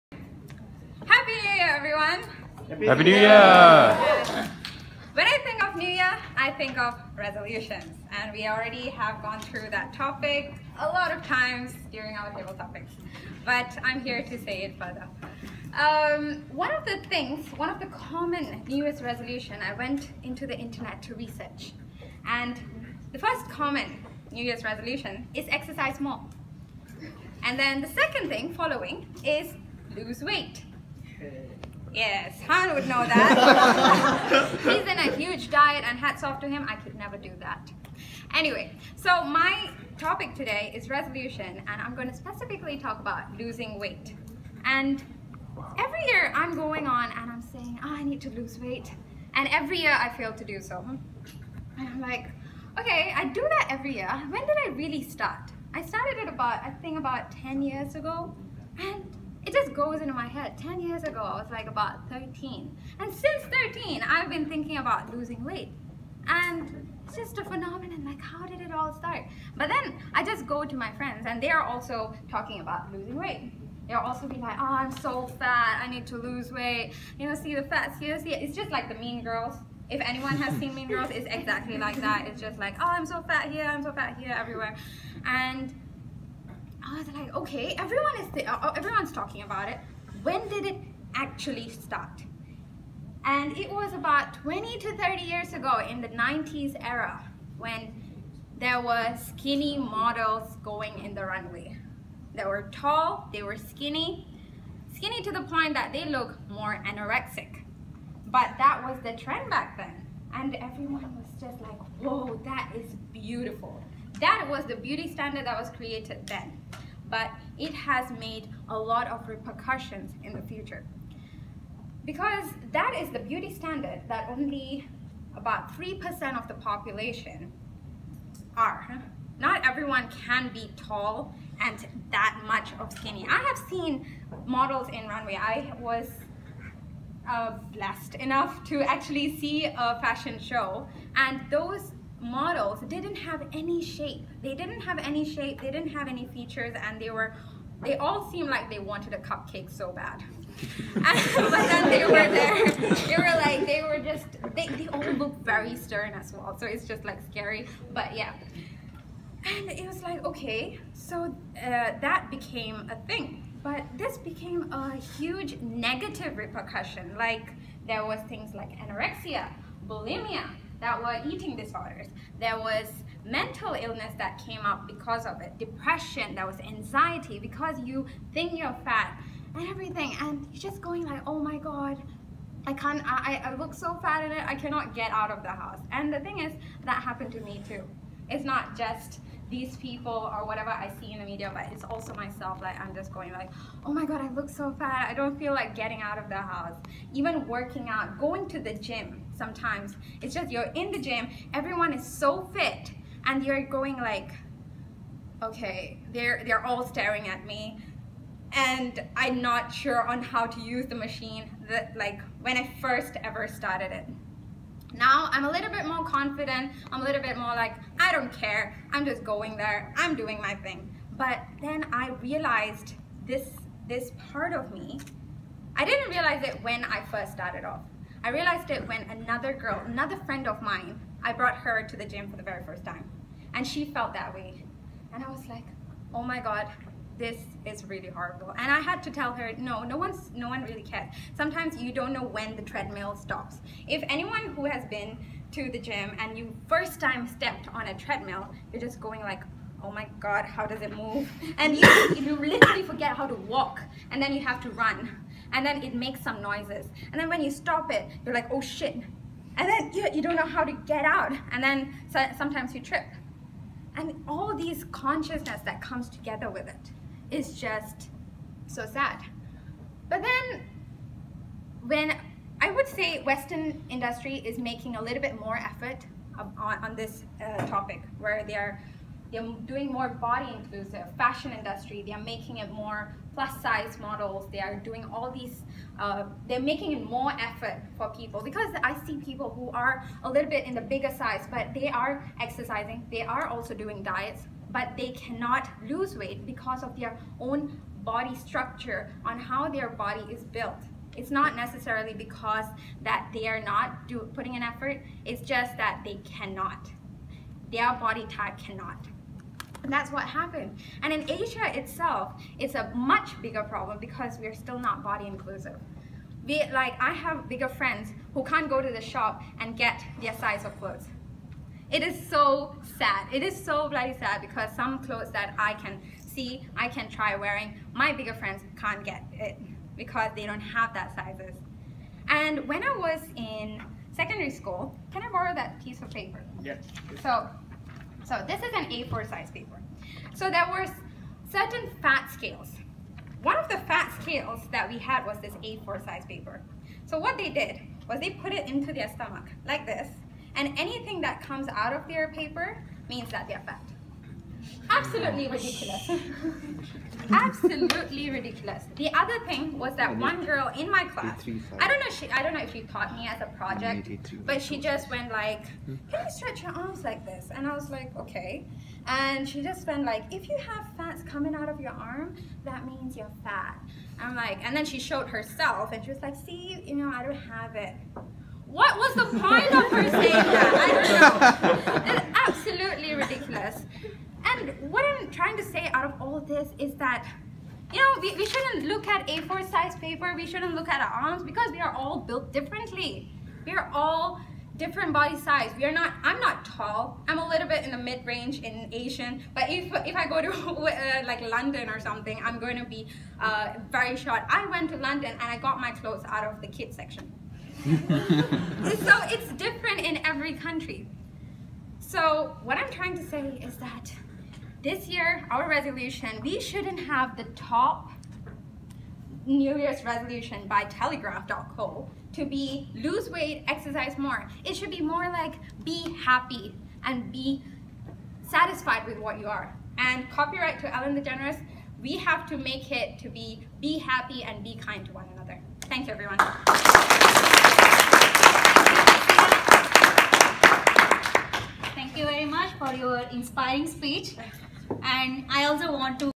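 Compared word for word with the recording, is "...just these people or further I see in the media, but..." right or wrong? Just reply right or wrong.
wrong.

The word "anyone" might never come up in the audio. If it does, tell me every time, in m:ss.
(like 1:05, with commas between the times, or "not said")
1:19, 4:04.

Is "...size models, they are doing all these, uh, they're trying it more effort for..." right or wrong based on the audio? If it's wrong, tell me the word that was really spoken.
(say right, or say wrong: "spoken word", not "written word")
wrong: "making", not "trying".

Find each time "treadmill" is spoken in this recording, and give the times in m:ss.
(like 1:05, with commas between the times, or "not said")
4:02, 4:07.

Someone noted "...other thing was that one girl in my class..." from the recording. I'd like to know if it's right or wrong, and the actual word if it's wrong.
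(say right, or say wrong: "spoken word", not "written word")
right.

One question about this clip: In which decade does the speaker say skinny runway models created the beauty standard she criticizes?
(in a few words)
the 90s.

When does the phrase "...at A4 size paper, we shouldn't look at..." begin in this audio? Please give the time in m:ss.
6:29.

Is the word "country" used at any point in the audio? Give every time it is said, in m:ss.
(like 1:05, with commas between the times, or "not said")
6:50.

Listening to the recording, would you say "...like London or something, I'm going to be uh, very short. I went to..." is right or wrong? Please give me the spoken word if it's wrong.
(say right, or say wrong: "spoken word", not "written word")
right.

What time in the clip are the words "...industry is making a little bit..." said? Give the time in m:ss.
4:33.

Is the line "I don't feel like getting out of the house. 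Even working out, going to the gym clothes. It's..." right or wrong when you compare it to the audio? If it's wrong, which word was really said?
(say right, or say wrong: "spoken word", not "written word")
wrong: "sometimes", not "clothes".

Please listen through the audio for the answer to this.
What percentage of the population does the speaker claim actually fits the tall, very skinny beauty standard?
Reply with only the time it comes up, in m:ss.
2:05.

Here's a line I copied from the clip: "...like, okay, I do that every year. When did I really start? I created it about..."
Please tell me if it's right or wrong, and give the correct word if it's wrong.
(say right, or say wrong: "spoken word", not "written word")
wrong: "started", not "created".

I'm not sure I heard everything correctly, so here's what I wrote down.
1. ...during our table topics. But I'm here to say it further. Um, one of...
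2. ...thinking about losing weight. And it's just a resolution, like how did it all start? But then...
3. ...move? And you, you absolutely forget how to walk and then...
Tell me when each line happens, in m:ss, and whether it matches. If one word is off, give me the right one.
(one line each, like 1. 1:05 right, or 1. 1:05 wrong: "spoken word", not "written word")
1. 0:11 right
2. 1:04 wrong: "phenomenon", not "resolution"
3. 4:10 wrong: "literally", not "absolutely".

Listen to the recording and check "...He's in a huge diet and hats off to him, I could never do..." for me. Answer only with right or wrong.
right.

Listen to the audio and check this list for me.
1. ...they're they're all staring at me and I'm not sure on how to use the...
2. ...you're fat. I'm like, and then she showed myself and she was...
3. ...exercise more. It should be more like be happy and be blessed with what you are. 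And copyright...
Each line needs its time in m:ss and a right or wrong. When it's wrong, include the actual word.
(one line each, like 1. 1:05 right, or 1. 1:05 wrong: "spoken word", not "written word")
1. 3:26 right
2. 6:13 wrong: "herself", not "myself"
3. 7:03 wrong: "satisfied", not "blessed".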